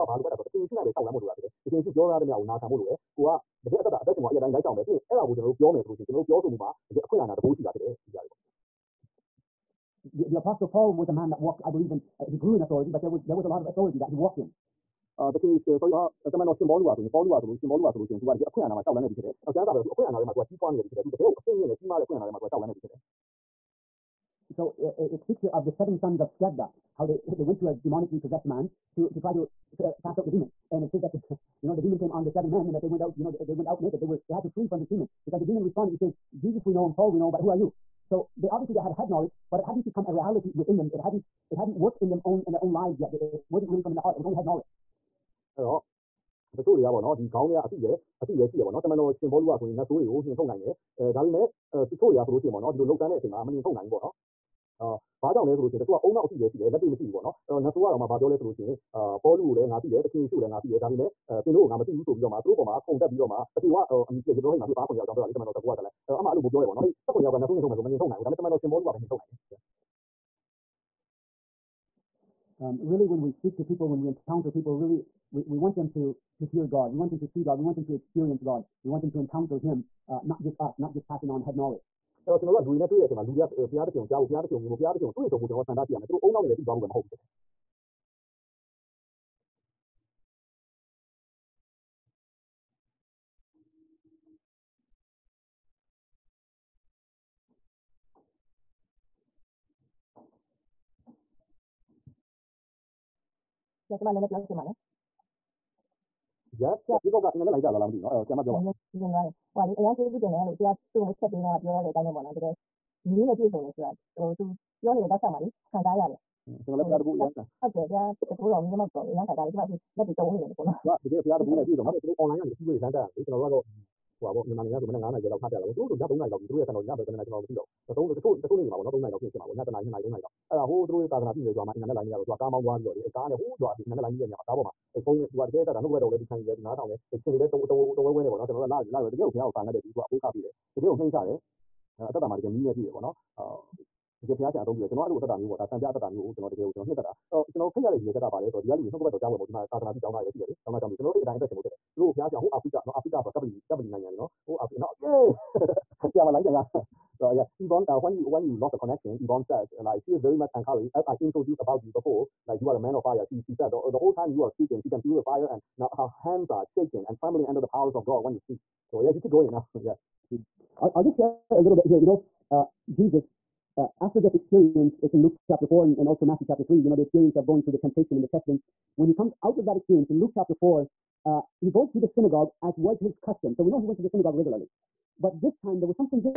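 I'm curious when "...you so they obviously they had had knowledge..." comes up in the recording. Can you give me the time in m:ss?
0:37.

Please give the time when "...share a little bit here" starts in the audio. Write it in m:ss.
2:51.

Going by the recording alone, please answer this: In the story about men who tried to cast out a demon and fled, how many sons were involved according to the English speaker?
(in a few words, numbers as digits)
7.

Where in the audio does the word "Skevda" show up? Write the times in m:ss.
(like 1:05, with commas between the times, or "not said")
0:26.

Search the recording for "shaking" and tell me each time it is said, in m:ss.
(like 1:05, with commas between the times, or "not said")
2:46.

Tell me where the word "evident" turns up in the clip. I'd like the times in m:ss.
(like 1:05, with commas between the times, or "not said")
not said.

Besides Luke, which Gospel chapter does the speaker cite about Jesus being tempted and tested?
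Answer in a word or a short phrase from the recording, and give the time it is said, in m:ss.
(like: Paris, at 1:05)
Matthew chapter 3, at 2:56.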